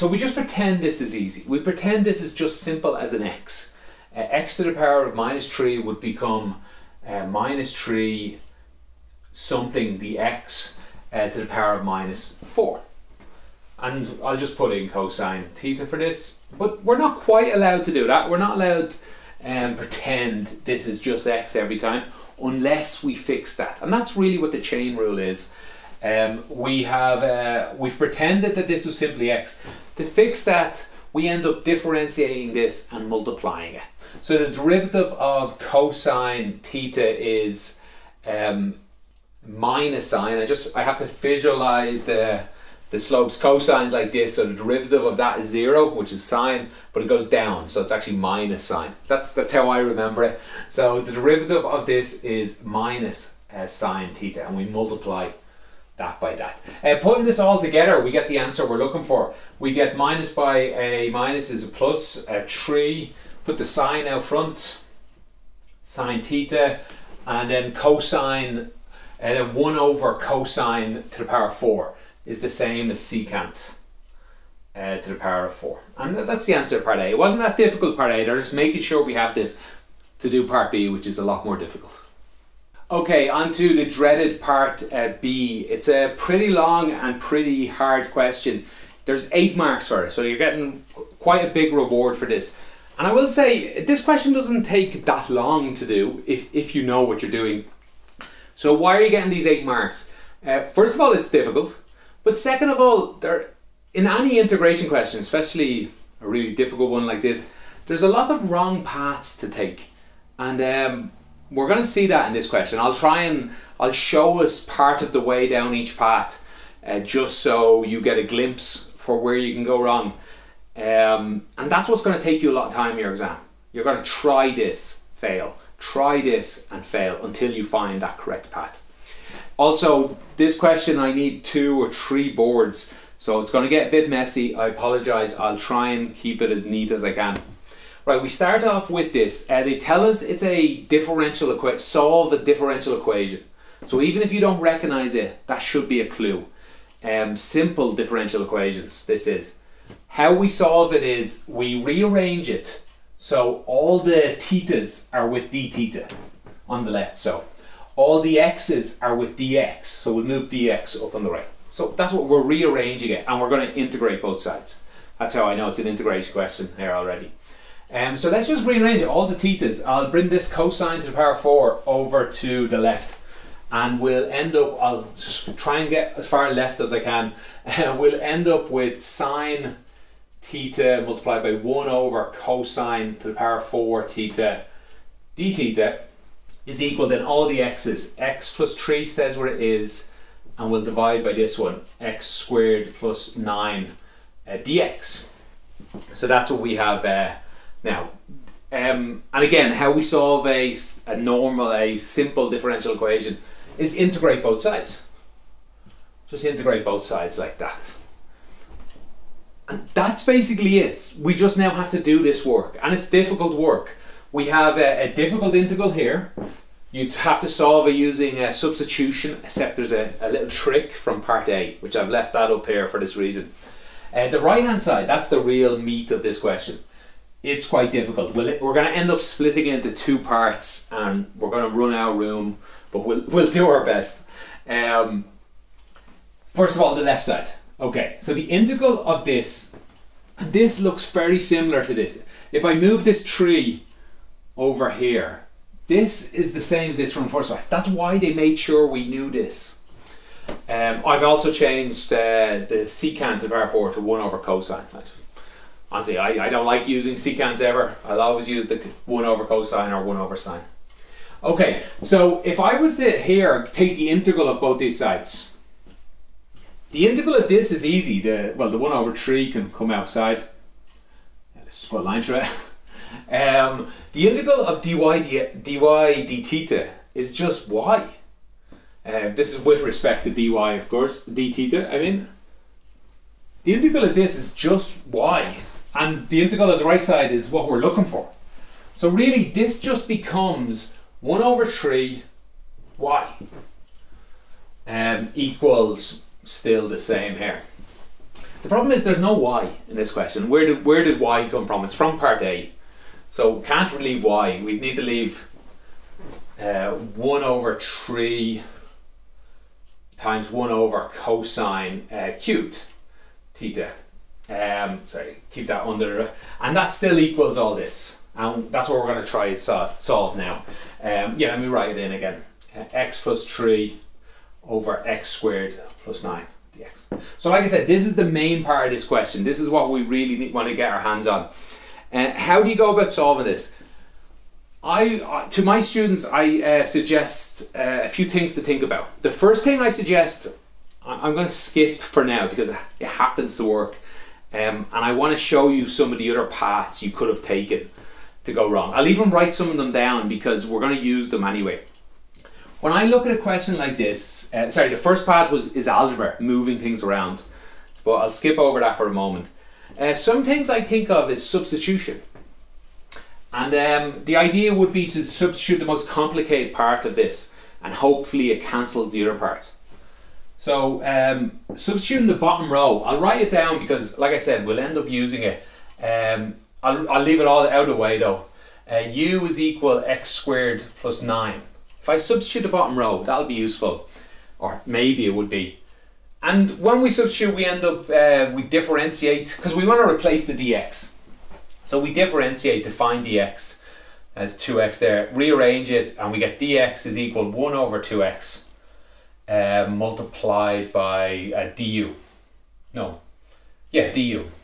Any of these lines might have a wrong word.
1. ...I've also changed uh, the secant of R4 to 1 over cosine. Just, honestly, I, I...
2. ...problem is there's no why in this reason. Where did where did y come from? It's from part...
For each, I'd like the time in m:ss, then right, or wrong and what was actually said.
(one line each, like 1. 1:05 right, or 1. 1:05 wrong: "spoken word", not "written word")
1. 4:11 right
2. 4:58 wrong: "question", not "reason".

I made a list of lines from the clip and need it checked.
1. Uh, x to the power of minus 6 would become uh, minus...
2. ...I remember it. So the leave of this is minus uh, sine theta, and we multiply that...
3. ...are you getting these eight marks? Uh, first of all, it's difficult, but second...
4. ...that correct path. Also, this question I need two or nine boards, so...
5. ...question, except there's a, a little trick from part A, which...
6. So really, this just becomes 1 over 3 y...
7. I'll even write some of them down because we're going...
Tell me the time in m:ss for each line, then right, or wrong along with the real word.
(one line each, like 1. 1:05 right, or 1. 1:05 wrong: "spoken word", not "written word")
1. 0:04 wrong: "3", not "6"
2. 0:49 wrong: "derivative", not "leave"
3. 1:38 right
4. 2:08 wrong: "three", not "nine"
5. 3:38 wrong: "substitution", not "question"
6. 4:48 right
7. 5:48 right.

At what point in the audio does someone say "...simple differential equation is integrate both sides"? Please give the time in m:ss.
3:21.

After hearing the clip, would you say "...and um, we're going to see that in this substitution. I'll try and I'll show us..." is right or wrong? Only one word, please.
wrong.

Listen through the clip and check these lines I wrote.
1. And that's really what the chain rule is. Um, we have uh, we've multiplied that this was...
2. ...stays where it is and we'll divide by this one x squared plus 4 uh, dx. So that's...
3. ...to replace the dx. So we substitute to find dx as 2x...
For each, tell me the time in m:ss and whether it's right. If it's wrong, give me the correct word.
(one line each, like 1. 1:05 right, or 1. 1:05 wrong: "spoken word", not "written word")
1. 0:23 wrong: "pretended", not "multiplied"
2. 3:09 wrong: "9", not "4"
3. 6:30 wrong: "differentiate", not "substitute".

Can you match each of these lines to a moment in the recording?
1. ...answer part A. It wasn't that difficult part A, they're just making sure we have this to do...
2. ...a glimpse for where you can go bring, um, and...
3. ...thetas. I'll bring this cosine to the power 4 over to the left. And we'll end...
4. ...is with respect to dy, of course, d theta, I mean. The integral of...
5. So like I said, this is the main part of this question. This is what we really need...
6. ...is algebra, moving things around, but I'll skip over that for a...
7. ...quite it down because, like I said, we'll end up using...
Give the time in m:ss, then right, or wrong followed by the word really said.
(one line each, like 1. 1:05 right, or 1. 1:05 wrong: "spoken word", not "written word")
1. 1:16 right
2. 1:58 wrong: "wrong", not "bring"
3. 2:49 right
4. 4:39 right
5. 5:27 right
6. 5:55 right
7. 6:13 wrong: "write", not "quite".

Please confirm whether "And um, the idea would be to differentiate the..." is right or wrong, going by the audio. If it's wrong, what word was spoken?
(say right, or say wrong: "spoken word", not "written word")
wrong: "substitute", not "differentiate".